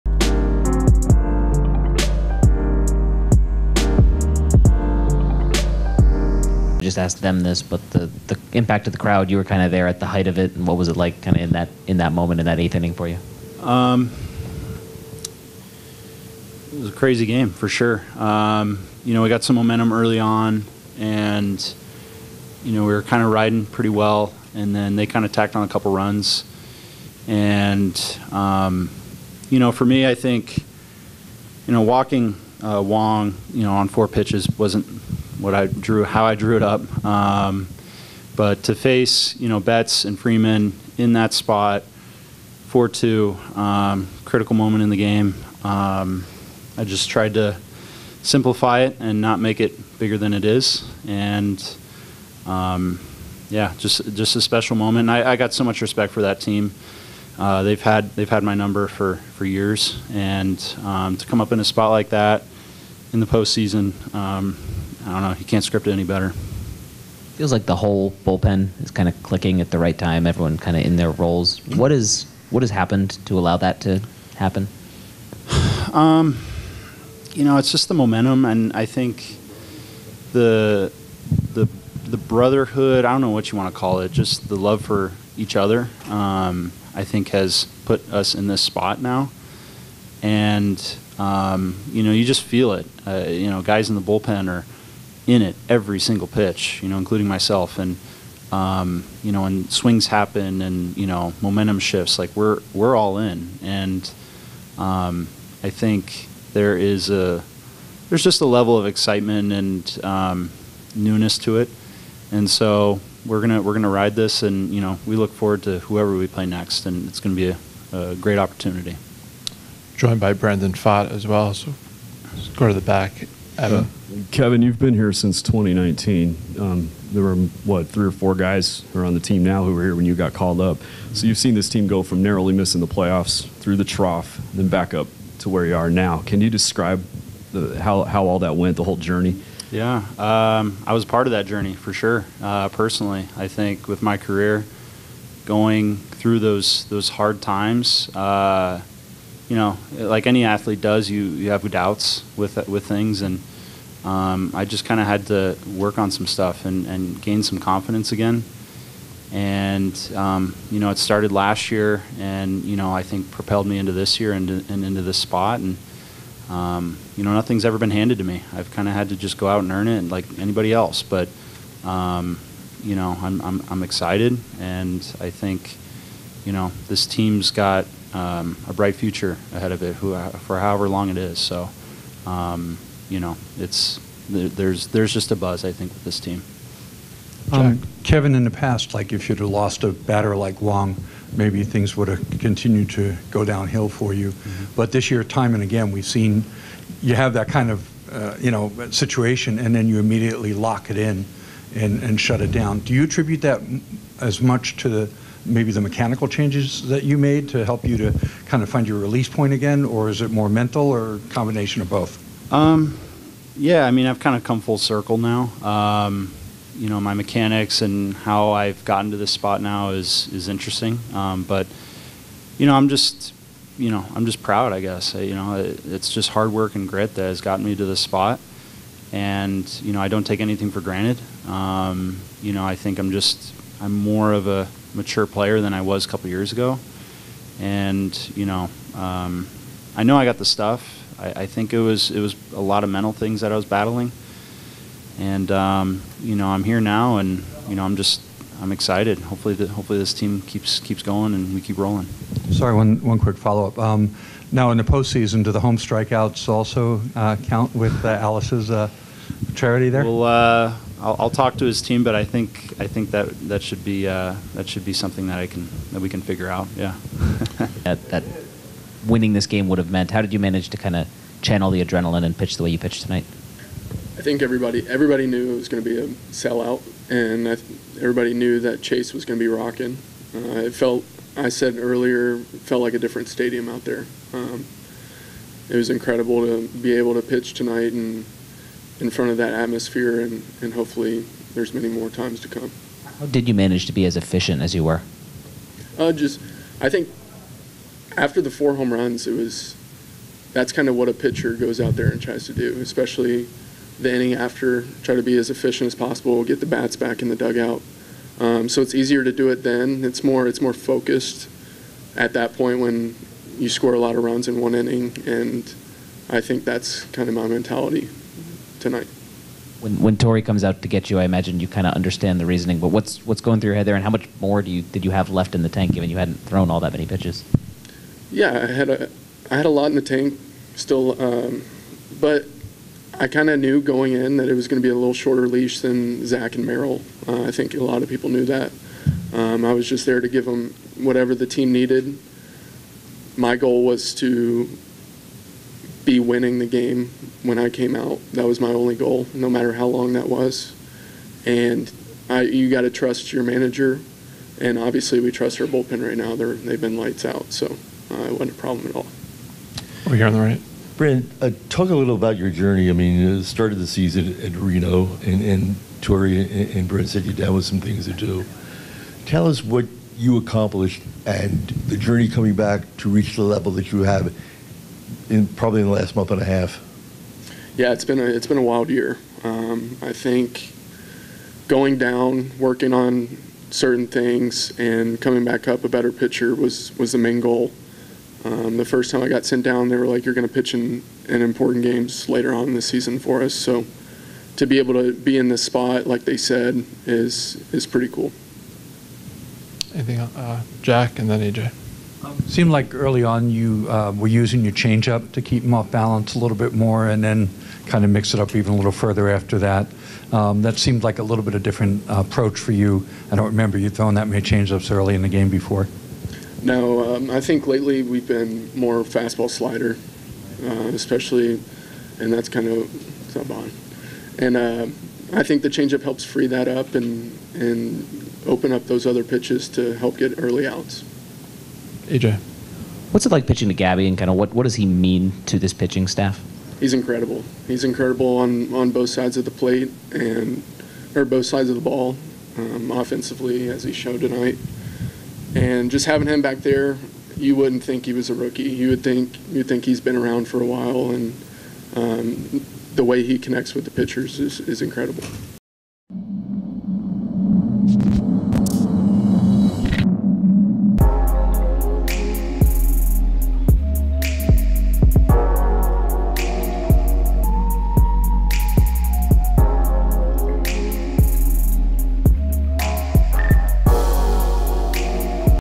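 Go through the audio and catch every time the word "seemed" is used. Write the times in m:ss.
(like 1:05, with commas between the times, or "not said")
6:42, 6:50.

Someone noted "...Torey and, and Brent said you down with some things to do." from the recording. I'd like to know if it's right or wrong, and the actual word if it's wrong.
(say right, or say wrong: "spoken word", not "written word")
right.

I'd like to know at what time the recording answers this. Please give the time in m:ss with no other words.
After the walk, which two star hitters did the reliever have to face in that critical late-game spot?
0:39.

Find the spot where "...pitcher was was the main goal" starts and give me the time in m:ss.
6:26.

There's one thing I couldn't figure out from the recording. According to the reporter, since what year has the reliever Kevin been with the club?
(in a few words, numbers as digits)
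2019.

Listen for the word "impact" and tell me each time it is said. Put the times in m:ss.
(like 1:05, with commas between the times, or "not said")
0:08.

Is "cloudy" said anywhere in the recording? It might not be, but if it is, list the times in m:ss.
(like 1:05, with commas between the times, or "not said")
not said.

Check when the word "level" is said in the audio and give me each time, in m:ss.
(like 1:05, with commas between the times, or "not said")
1:48, 6:13.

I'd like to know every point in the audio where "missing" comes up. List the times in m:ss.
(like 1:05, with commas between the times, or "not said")
2:12.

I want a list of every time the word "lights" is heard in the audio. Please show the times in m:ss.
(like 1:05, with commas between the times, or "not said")
5:56.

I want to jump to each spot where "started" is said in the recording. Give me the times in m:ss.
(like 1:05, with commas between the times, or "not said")
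2:40, 6:03.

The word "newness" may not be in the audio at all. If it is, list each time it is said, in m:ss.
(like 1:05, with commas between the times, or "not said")
1:50.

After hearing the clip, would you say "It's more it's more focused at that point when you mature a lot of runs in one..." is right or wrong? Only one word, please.
wrong.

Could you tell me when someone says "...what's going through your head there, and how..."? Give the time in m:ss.
5:23.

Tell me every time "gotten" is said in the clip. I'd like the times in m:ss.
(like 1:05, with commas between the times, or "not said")
3:38, 3:47.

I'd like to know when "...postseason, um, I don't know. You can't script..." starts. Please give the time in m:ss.
1:03.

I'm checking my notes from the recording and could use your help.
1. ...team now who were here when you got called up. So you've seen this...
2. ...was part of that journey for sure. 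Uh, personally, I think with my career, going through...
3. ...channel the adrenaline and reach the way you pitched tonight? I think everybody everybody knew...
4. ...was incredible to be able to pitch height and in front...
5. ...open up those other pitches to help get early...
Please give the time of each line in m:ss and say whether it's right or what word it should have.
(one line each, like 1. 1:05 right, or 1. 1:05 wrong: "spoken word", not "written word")
1. 2:09 right
2. 2:20 right
3. 4:31 wrong: "pitch", not "reach"
4. 4:45 wrong: "tonight", not "height"
5. 7:08 right.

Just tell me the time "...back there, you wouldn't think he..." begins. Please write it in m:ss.
7:26.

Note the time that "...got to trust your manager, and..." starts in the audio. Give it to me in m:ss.
5:52.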